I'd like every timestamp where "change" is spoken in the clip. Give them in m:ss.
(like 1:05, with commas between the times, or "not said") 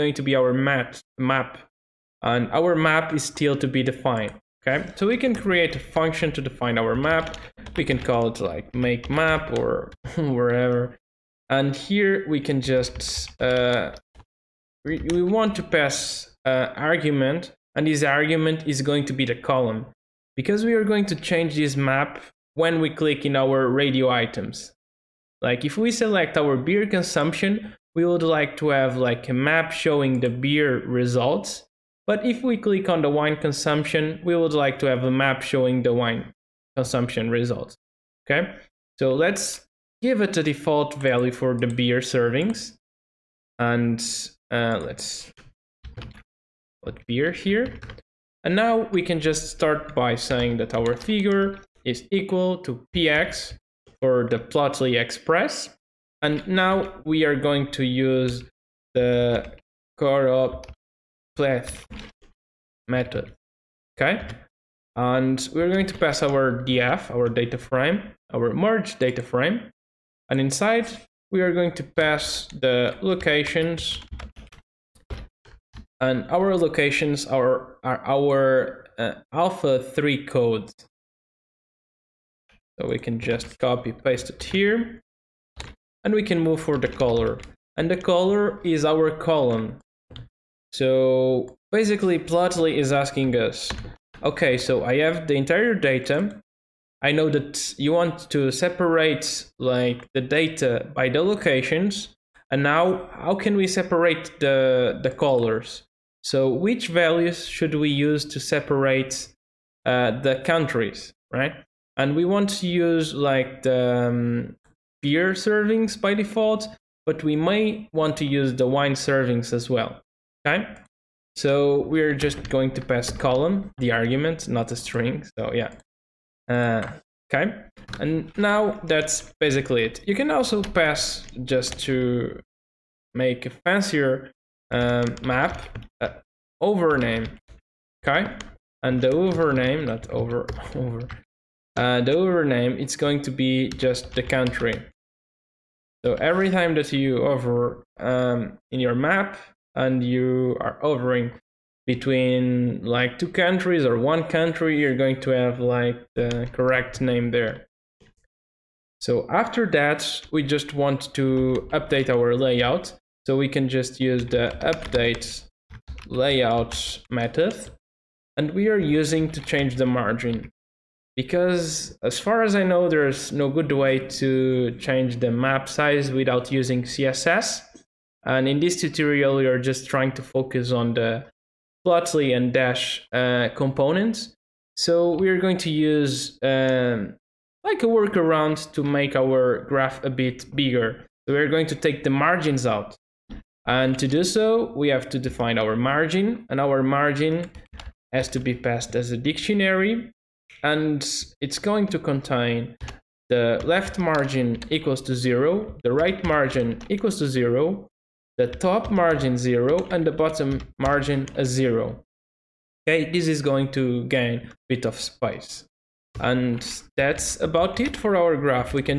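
0:21, 2:49, 2:54.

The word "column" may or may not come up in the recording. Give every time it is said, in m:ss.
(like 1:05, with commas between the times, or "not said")
0:19, 1:29, 2:03.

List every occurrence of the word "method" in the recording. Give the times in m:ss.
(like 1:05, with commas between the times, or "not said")
1:02, 2:47.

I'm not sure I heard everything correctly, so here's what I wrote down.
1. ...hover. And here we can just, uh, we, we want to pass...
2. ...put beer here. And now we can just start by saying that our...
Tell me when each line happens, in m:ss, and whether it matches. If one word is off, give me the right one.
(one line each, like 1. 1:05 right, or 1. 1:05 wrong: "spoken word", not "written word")
1. 0:10 wrong: "wherever", not "hover"
2. 0:46 right.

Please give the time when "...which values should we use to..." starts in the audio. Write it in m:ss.
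1:46.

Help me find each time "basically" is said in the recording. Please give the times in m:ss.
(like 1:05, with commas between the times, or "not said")
1:31, 2:09.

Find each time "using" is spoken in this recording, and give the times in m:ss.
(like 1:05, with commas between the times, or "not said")
2:48, 2:56.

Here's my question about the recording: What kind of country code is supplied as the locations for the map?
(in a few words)
alpha 3 code.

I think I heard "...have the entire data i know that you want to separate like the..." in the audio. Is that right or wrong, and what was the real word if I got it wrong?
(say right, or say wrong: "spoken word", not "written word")
right.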